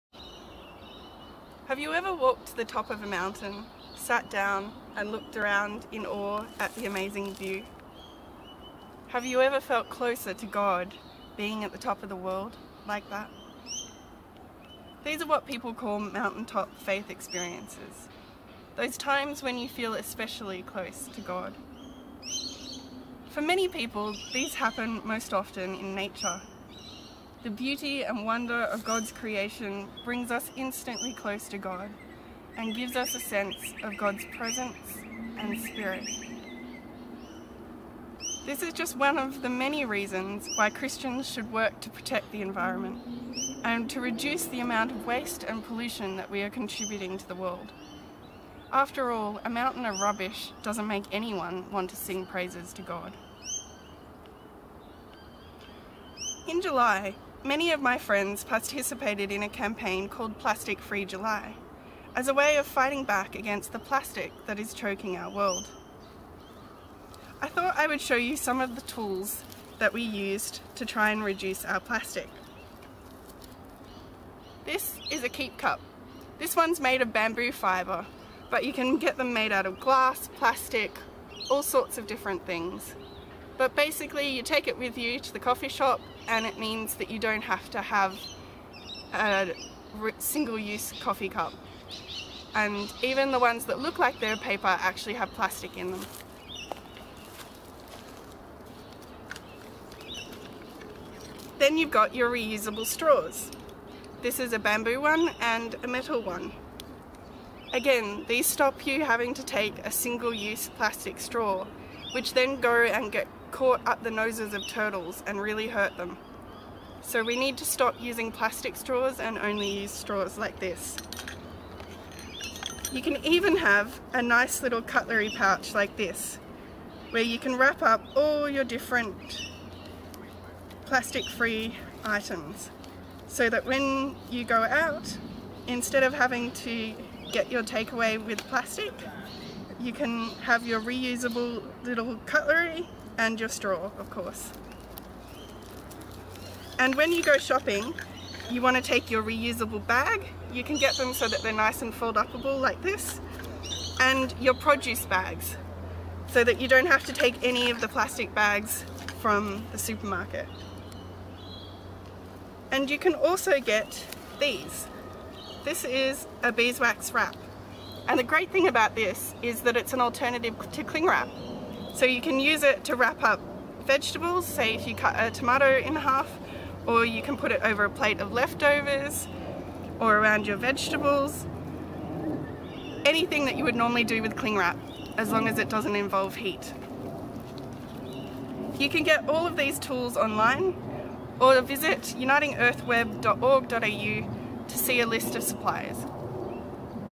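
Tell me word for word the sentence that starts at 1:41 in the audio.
Then you've got your reusable straws.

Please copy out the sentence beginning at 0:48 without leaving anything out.
After all, a mountain of rubbish doesn't make anyone want to sing praises to God.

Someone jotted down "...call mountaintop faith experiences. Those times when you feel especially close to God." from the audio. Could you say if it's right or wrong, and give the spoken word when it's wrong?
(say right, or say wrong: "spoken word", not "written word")
right.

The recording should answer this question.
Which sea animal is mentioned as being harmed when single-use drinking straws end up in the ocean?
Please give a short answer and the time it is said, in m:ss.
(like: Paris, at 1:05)
turtles, at 1:54.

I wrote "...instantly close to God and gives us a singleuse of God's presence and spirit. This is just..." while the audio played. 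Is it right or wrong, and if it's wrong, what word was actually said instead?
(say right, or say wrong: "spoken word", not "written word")
wrong: "sense", not "singleuse".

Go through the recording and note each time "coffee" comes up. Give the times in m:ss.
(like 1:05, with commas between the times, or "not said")
1:25, 1:30.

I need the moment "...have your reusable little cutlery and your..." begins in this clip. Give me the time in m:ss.
2:20.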